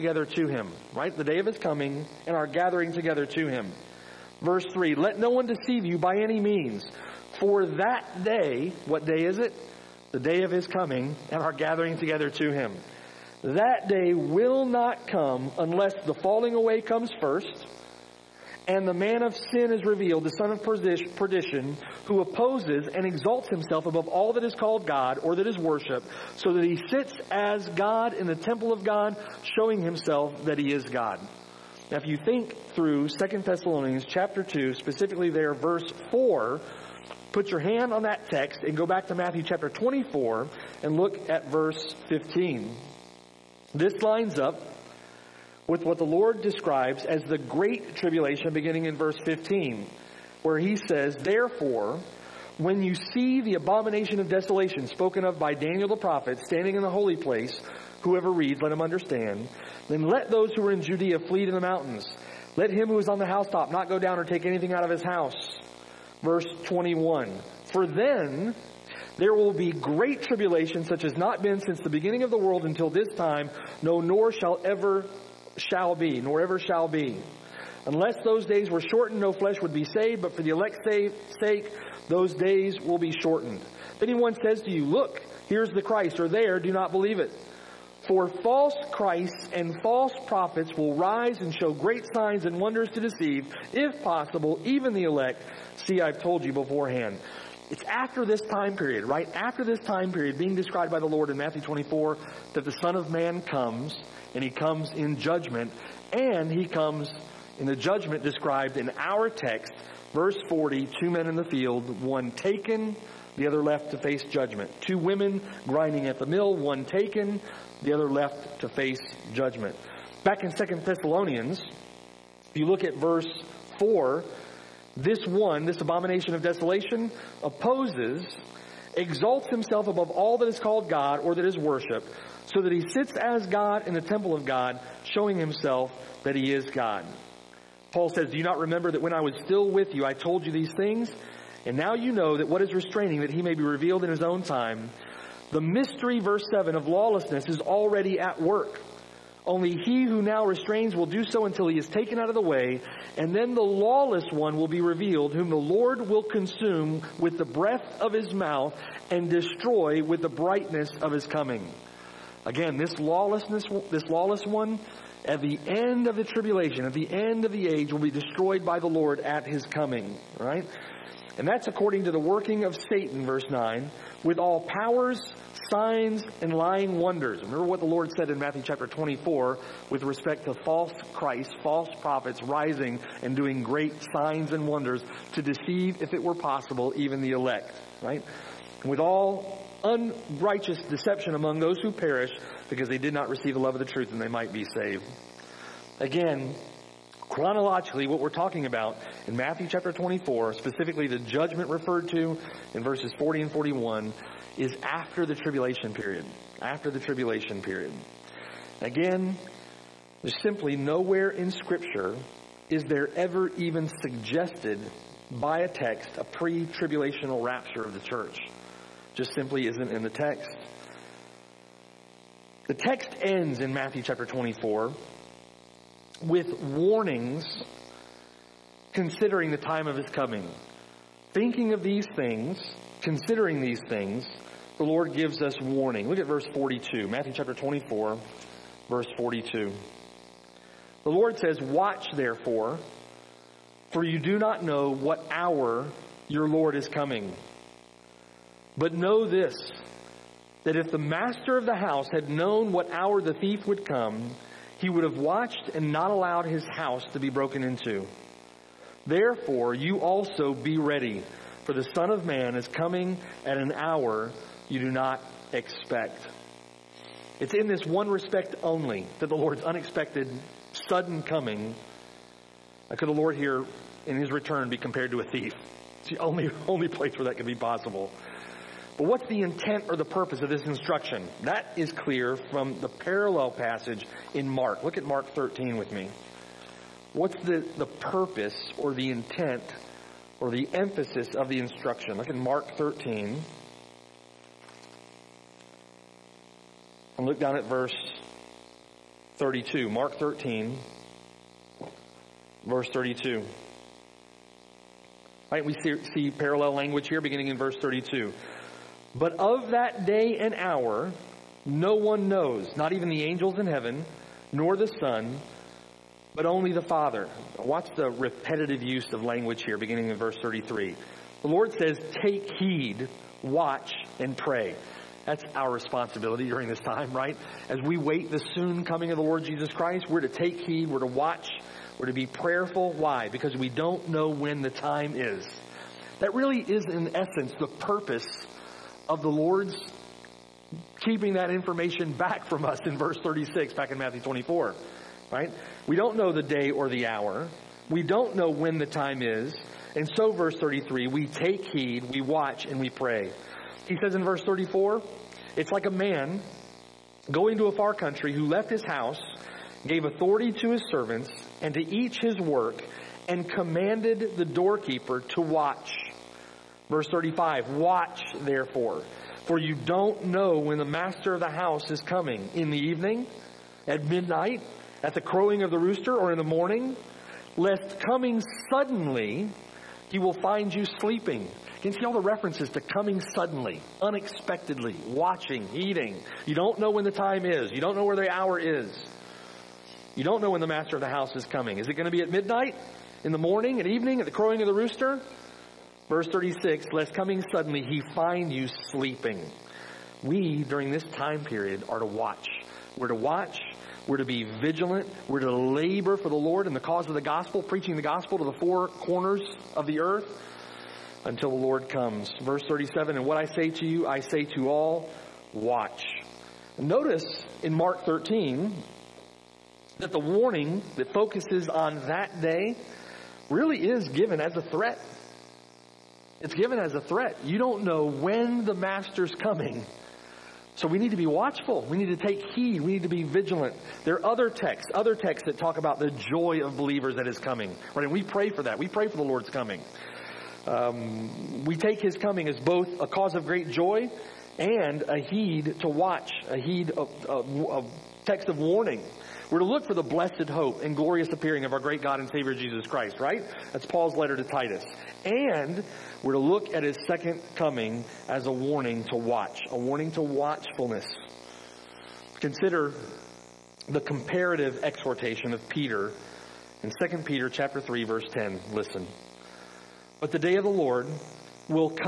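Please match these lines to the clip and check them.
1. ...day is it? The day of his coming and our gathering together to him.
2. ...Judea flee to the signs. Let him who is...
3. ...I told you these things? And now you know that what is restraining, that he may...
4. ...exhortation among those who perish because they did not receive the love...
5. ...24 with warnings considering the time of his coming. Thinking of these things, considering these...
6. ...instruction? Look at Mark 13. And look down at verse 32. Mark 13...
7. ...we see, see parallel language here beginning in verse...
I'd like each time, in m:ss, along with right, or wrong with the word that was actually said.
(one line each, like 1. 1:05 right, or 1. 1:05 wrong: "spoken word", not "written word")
1. 0:09 right
2. 1:00 wrong: "mountains", not "signs"
3. 2:20 right
4. 3:10 wrong: "deception", not "exhortation"
5. 3:44 right
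6. 4:51 right
7. 5:05 right.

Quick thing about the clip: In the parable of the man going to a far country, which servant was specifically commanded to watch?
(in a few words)
The doorkeeper.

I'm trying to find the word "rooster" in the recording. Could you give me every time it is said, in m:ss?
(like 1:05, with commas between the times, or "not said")
6:15, 6:34.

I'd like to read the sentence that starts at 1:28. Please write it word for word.
For false Christs and false prophets will rise and show great signs and wonders to deceive, if possible, even the elect.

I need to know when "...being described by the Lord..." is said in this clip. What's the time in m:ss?
1:40.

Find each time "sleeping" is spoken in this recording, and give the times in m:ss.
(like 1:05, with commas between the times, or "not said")
6:20, 6:38.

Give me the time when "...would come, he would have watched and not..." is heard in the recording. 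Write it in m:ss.
4:13.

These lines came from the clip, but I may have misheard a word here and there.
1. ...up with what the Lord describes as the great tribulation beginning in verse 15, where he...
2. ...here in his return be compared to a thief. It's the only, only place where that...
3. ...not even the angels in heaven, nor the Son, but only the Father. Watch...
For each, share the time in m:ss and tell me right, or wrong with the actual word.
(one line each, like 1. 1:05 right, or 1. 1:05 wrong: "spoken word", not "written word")
1. 0:44 right
2. 4:33 right
3. 5:12 right.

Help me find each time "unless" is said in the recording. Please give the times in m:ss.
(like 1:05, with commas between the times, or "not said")
0:15, 1:17.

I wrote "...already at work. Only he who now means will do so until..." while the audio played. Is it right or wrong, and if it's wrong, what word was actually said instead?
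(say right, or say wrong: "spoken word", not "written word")
wrong: "restrains", not "means".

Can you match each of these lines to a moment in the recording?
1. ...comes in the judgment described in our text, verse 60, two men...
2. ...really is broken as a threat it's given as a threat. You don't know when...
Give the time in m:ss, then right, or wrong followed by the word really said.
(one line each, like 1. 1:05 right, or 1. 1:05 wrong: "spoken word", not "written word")
1. 1:46 wrong: "40", not "60"
2. 7:03 wrong: "given", not "broken".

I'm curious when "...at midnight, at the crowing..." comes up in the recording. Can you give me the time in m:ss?
6:13.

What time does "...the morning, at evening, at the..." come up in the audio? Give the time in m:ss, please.
6:33.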